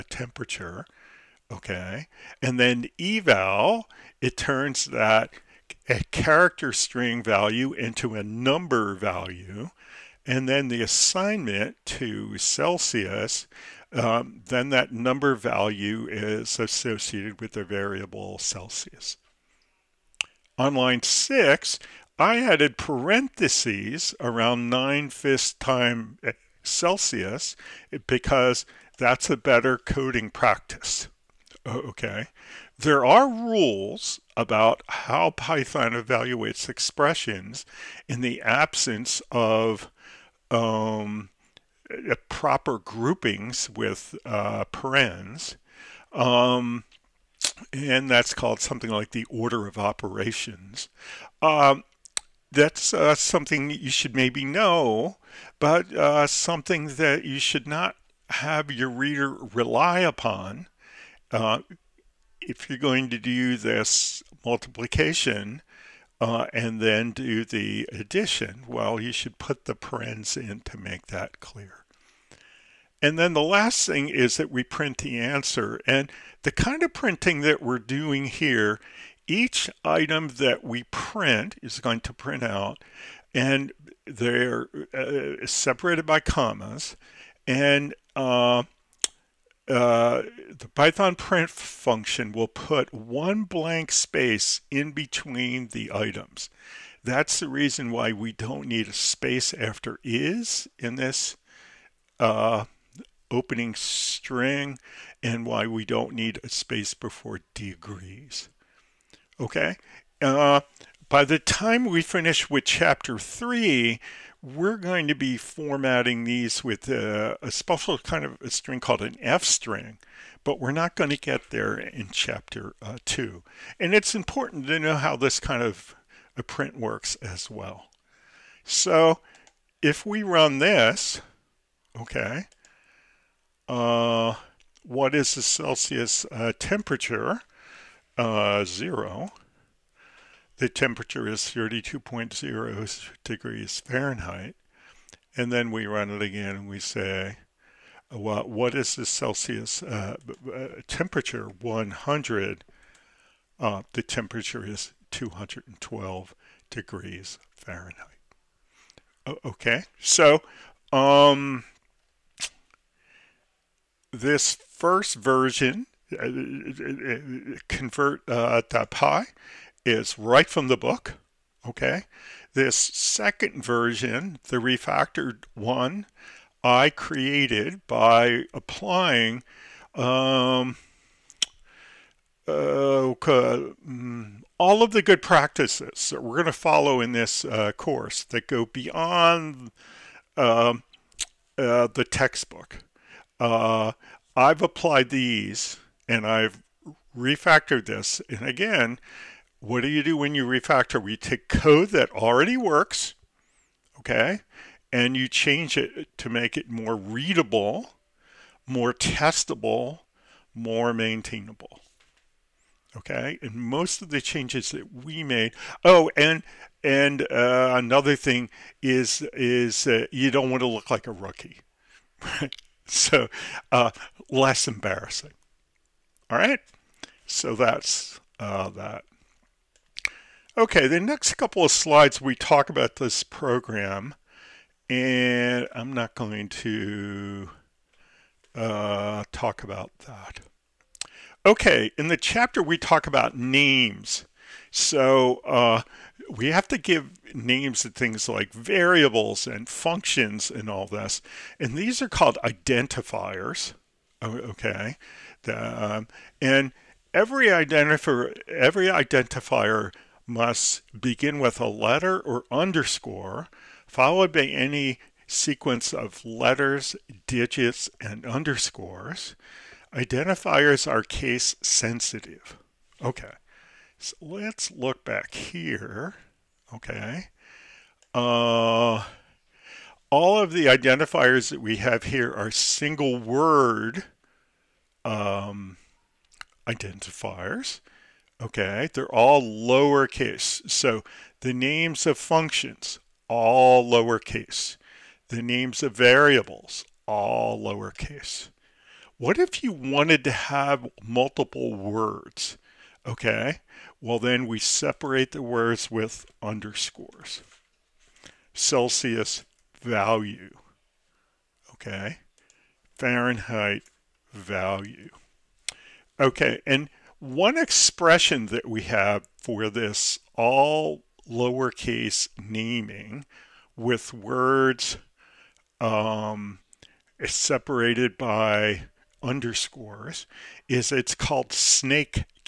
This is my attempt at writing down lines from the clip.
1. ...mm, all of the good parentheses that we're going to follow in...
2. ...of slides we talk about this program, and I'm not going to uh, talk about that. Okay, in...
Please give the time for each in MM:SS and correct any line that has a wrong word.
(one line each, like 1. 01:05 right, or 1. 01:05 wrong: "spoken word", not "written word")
1. 03:03 wrong: "practices", not "parentheses"
2. 03:51 right.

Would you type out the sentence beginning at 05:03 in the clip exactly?
Okay, well then we separate the words with underscores.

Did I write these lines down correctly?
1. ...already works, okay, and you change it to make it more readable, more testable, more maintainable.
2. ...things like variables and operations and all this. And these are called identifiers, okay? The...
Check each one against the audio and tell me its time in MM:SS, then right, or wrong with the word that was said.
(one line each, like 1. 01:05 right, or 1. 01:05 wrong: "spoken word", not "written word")
1. 03:22 right
2. 04:07 wrong: "functions", not "operations".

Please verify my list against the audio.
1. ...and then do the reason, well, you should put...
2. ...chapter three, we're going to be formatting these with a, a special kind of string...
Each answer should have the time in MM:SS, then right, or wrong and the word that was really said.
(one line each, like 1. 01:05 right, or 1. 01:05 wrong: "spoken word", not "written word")
1. 01:06 wrong: "addition", not "reason"
2. 01:52 right.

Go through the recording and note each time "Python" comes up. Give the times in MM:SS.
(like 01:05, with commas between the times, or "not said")
00:35, 01:30.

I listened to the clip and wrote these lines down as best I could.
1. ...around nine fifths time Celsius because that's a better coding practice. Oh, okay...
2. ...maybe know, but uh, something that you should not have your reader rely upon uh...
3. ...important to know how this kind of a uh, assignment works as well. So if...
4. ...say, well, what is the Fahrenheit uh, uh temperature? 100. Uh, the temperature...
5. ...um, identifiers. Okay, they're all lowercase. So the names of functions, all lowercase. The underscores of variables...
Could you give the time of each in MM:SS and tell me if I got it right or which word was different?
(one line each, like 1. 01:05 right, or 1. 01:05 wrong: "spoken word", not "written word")
1. 00:24 right
2. 00:54 right
3. 02:04 wrong: "print", not "assignment"
4. 02:26 wrong: "Celsius", not "Fahrenheit"
5. 04:45 wrong: "names", not "underscores".